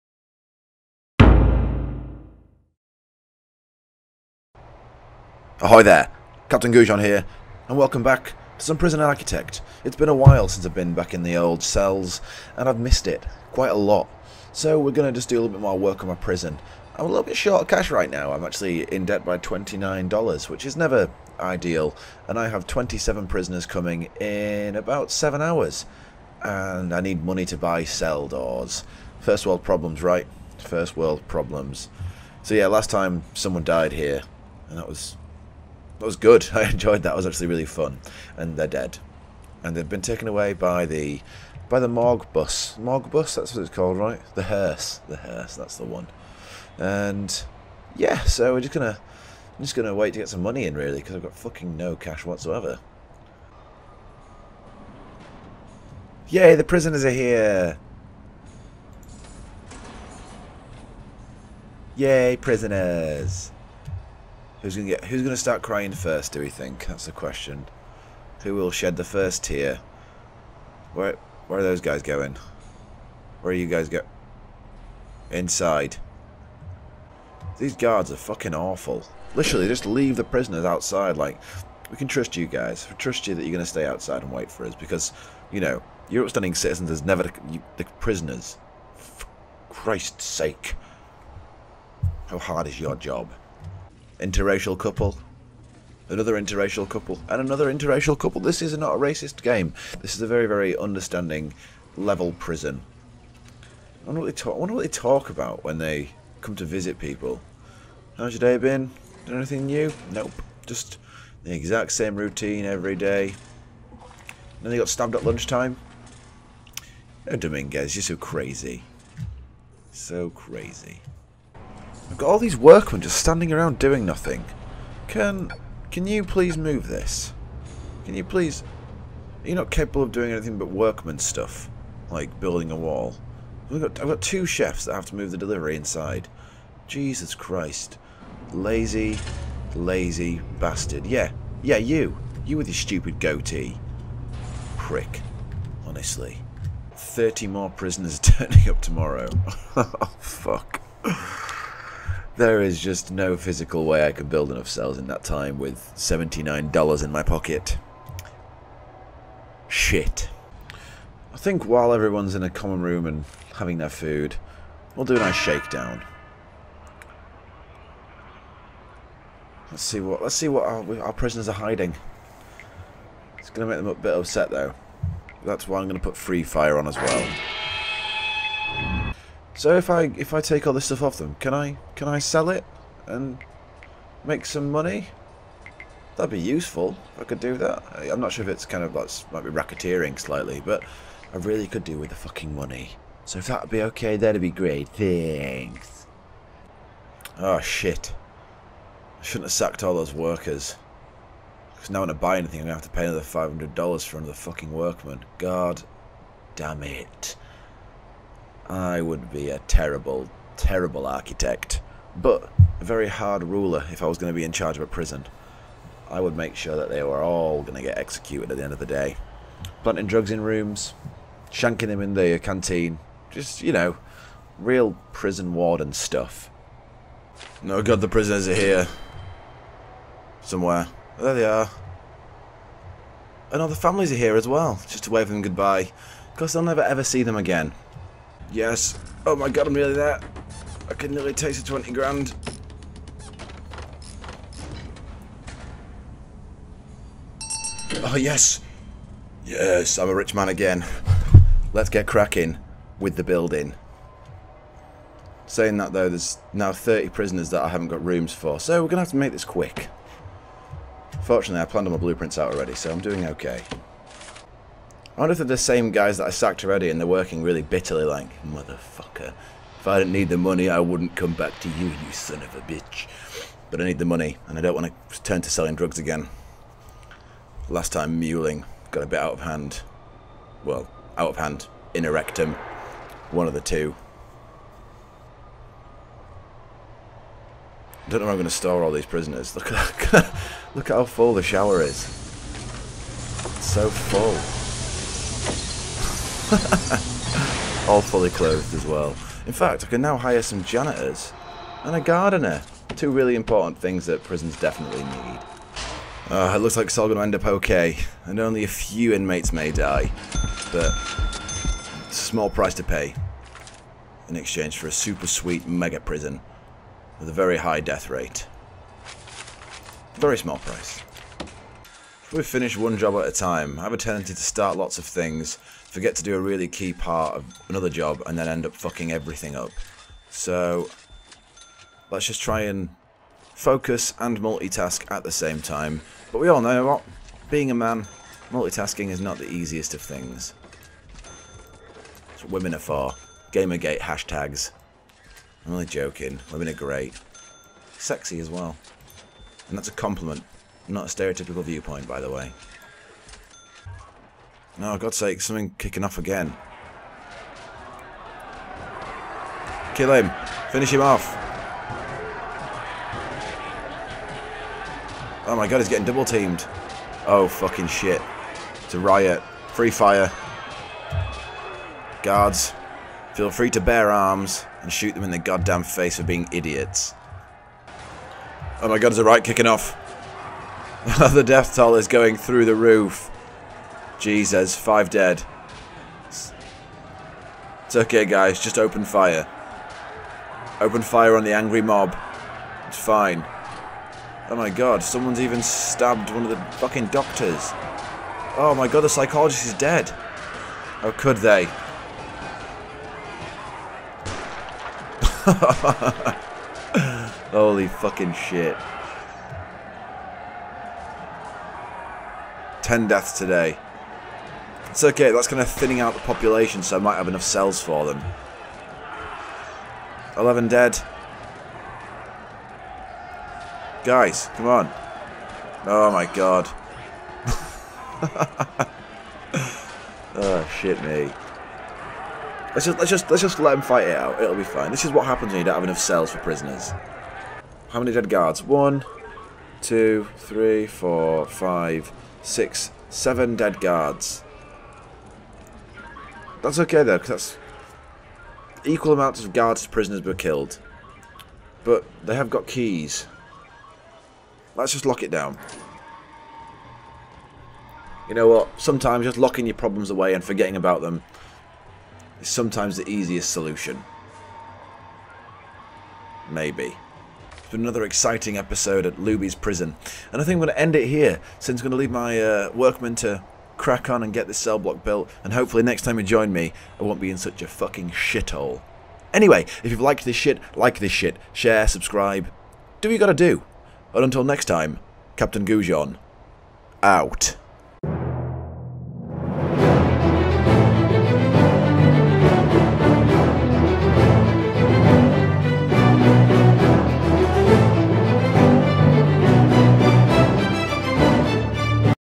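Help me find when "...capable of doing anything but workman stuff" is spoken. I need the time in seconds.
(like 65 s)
129 s.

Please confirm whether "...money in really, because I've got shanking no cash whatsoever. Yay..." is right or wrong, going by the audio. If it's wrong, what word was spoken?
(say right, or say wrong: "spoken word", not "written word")
wrong: "fucking", not "shanking".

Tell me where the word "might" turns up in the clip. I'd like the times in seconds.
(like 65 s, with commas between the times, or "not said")
189 s, 416 s.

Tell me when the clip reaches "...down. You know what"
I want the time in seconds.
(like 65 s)
455 s.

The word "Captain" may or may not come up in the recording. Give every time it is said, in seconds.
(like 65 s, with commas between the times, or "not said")
6 s, 485 s.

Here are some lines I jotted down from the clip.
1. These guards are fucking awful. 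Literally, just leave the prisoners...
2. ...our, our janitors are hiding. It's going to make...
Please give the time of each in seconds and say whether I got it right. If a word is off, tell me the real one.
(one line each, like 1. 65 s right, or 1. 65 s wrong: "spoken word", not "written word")
1. 77 s right
2. 170 s wrong: "prisoners", not "janitors".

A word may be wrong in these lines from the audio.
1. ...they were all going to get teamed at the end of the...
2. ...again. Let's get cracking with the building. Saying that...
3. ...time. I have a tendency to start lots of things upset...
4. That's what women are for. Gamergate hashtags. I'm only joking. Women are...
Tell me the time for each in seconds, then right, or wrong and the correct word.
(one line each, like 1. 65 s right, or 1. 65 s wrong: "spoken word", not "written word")
1. 216 s wrong: "executed", not "teamed"
2. 250 s right
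3. 323 s wrong: "forget", not "upset"
4. 342 s right.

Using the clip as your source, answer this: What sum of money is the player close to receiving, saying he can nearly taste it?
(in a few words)
20 grand.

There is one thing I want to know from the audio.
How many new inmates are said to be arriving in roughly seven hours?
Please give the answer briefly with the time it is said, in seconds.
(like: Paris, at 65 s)
27, at 22 s.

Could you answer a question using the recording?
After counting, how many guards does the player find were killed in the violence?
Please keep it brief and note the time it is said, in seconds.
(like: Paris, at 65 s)
7, at 443 s.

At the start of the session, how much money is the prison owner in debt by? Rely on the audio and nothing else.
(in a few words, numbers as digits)
$29.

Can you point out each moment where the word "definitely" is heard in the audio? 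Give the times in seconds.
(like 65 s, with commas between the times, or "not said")
304 s.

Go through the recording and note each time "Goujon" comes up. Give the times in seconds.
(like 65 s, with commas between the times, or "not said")
6 s, 485 s.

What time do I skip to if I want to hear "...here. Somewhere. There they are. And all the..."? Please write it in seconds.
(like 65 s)
228 s.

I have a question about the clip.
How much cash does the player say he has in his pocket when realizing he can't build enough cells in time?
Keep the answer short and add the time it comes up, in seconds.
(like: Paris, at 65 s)
$79, at 155 s.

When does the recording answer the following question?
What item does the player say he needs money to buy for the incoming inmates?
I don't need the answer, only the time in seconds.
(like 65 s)
27 s.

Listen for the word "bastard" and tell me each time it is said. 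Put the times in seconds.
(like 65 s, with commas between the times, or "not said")
140 s.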